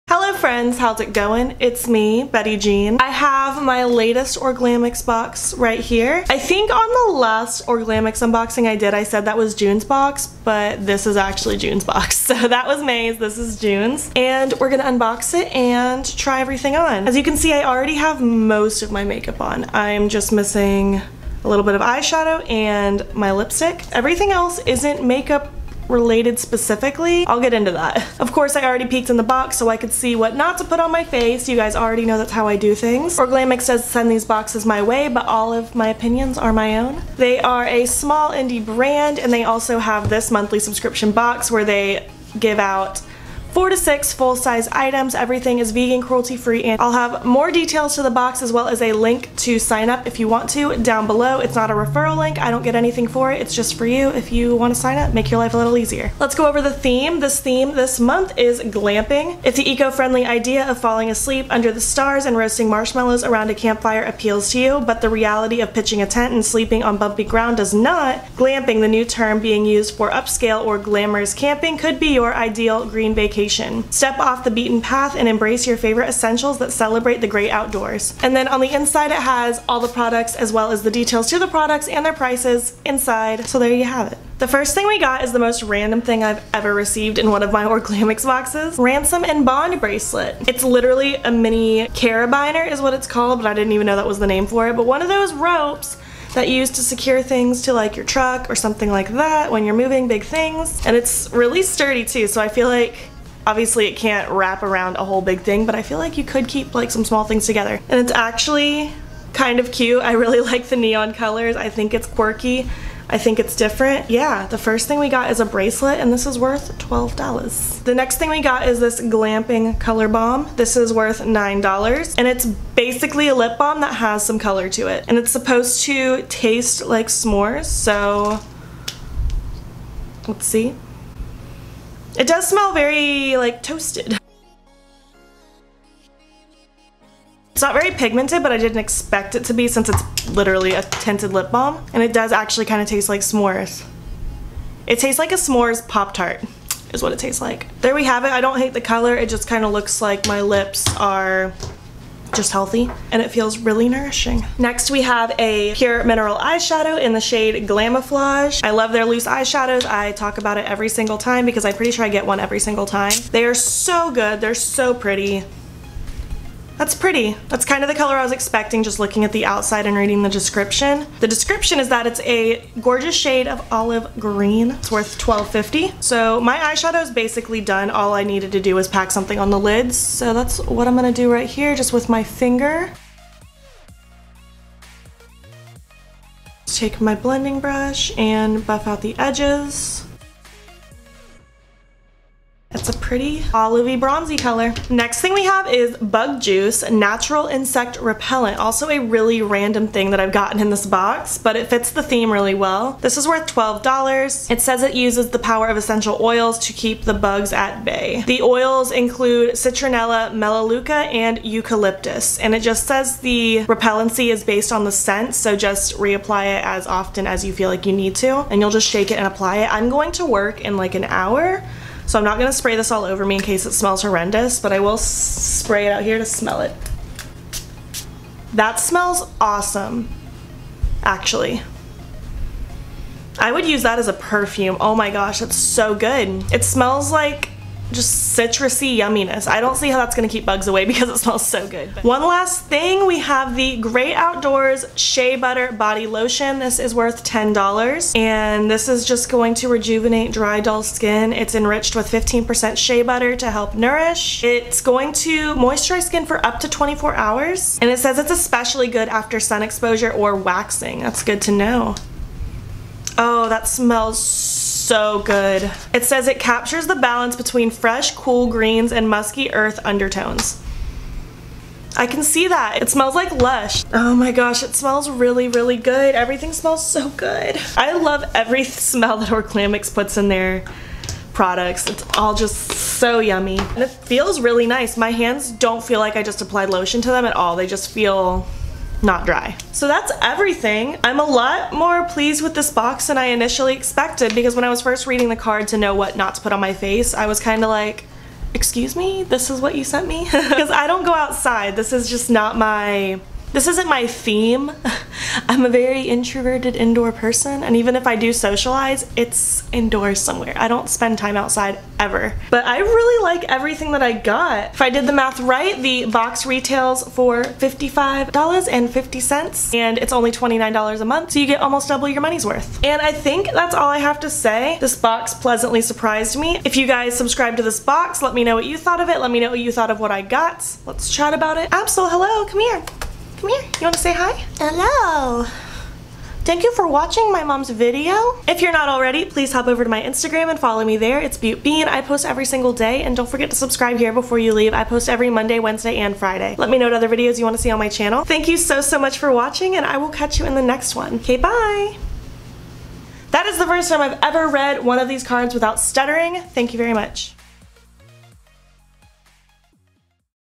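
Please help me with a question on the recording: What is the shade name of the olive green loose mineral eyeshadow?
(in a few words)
Glamouflage.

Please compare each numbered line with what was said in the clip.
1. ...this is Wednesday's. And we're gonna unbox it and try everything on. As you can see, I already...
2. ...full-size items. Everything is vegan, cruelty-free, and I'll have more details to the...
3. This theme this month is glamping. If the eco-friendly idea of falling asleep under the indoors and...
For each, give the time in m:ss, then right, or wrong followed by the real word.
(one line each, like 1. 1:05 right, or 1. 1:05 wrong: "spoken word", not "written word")
1. 0:13 wrong: "June", not "Wednesday"
2. 0:44 right
3. 0:57 wrong: "stars", not "indoors".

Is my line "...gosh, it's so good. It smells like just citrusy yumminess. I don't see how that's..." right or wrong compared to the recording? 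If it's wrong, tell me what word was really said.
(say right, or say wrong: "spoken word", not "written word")
right.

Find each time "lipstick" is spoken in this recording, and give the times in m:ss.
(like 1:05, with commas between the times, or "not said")
0:23.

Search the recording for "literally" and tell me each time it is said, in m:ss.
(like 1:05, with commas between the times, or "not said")
1:30, 2:20.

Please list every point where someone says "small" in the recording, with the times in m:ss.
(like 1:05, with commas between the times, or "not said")
0:37, 1:47.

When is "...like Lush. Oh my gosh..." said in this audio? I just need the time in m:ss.
4:33.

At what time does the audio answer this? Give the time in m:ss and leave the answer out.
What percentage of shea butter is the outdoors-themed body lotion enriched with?
4:12.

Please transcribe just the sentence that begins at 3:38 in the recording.
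And you'll just shake it and apply it.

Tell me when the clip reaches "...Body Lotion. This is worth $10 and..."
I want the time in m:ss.
4:05.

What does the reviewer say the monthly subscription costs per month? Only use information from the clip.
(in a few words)
$29.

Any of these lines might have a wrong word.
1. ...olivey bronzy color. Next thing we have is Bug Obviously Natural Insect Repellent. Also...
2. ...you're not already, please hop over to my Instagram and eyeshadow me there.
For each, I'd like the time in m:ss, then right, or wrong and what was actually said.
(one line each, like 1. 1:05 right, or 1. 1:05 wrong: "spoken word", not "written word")
1. 3:13 wrong: "Juice", not "Obviously"
2. 5:38 wrong: "follow", not "eyeshadow".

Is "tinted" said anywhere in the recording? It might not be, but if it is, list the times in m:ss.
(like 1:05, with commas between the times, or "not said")
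2:20.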